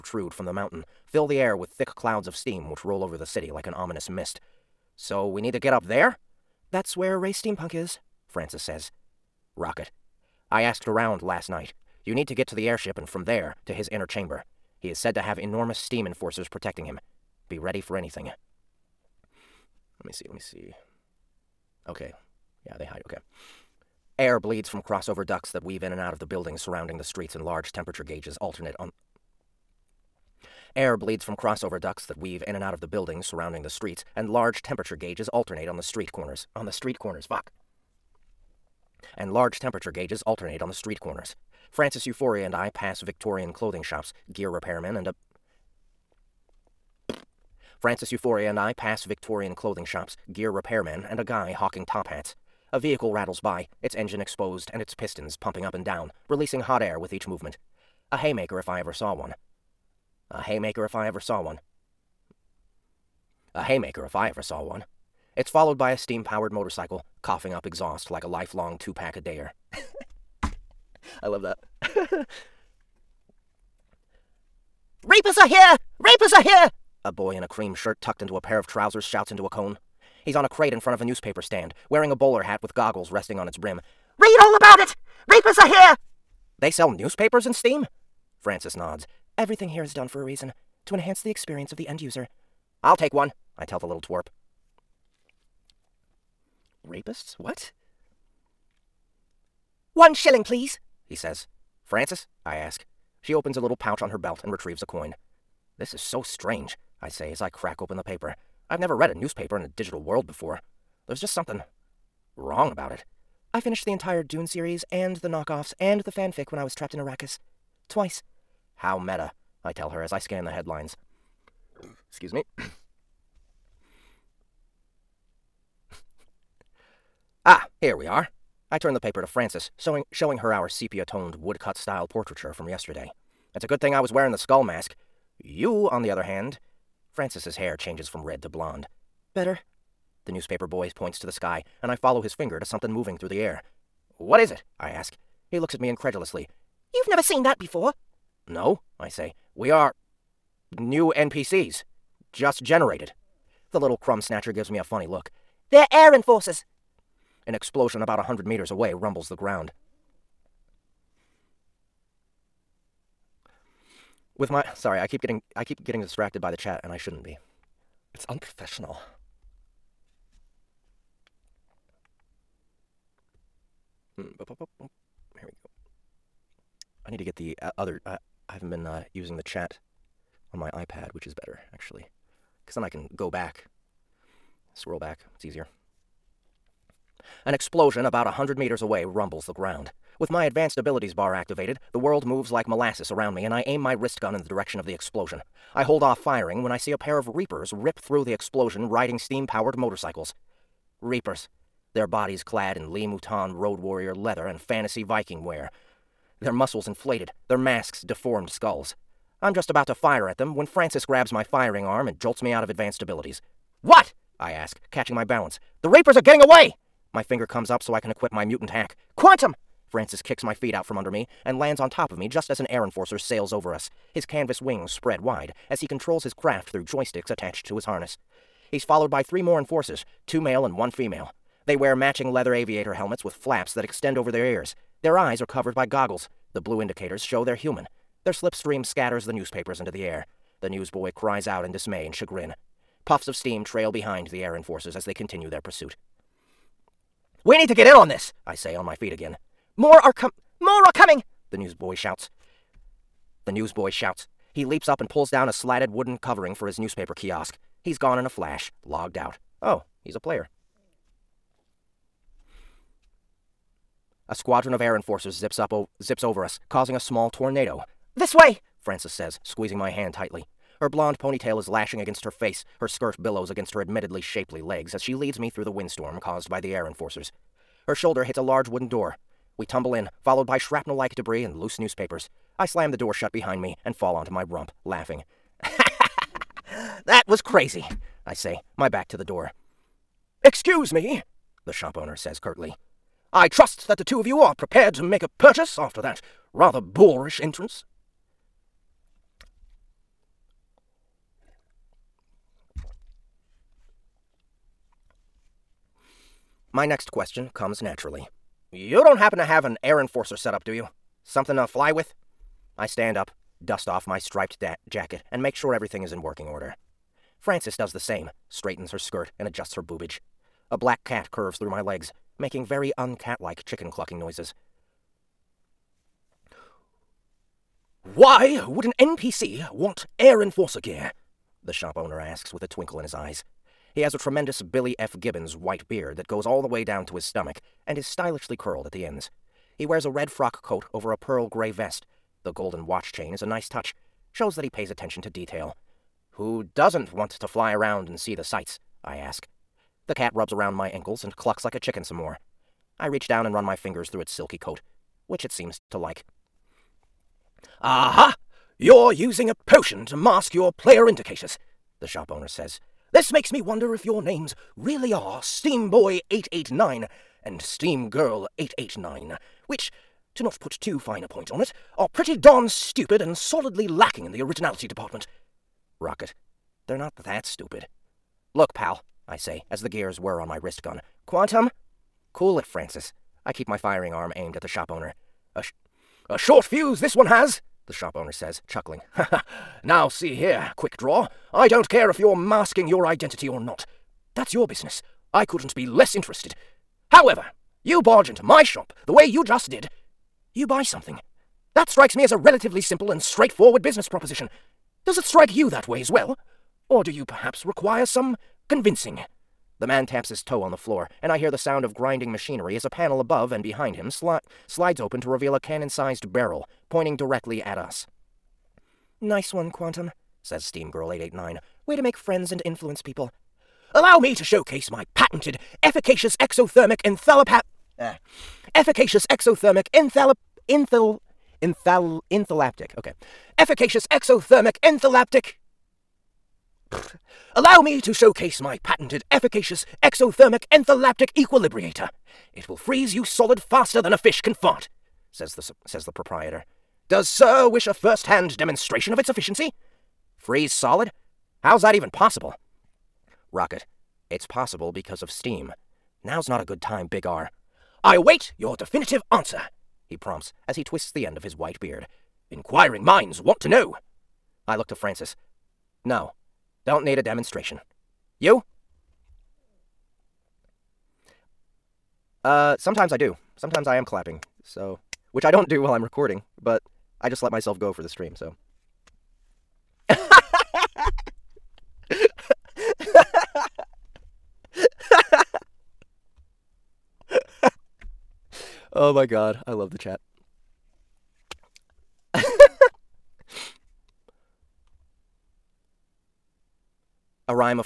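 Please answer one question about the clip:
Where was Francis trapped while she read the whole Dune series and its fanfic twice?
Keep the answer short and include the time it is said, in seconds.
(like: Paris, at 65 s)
Arrakis, at 116 s.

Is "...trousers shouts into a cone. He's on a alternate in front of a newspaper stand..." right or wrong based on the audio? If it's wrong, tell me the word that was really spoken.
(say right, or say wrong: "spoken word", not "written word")
wrong: "crate", not "alternate".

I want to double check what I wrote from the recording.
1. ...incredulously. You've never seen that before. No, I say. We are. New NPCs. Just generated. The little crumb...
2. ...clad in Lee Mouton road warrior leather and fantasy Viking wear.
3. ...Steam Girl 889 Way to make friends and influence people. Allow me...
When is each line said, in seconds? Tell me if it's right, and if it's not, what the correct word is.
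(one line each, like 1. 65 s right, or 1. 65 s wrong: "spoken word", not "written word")
1. 145 s right
2. 202 s right
3. 420 s right.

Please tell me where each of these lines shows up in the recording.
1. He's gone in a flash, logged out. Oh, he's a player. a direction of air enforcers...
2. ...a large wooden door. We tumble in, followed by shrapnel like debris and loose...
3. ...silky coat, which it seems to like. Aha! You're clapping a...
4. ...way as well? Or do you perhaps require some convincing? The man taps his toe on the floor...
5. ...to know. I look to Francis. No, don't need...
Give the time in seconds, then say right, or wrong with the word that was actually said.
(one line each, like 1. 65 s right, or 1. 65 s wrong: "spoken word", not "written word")
1. 257 s wrong: "squadron", not "direction"
2. 278 s right
3. 354 s wrong: "using", not "clapping"
4. 405 s right
5. 463 s right.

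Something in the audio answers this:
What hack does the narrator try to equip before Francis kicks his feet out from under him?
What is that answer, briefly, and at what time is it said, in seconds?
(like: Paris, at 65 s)
Mutant hack, at 218 s.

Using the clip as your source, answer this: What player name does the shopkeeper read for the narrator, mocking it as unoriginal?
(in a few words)
Steamboy889.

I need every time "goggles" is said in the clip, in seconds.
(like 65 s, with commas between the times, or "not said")
82 s, 235 s.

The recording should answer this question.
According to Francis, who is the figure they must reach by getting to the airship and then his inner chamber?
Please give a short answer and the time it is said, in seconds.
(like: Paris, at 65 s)
Ray Steampunk, at 7 s.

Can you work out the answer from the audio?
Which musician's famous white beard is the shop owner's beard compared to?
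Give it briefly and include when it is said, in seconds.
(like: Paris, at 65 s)
Billy F. Gibbons, at 334 s.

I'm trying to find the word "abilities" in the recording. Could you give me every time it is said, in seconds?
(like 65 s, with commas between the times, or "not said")
190 s, 213 s.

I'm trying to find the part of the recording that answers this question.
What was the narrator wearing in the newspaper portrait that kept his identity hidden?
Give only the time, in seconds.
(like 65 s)
134 s.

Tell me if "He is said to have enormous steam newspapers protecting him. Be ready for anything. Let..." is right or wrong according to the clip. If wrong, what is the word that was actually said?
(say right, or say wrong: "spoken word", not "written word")
wrong: "enforcers", not "newspapers".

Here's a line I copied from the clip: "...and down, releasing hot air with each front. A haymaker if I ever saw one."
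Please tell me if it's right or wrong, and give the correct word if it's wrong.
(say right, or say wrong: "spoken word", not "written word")
wrong: "movement", not "front".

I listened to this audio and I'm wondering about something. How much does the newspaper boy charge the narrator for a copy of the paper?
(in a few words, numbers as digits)
One shilling.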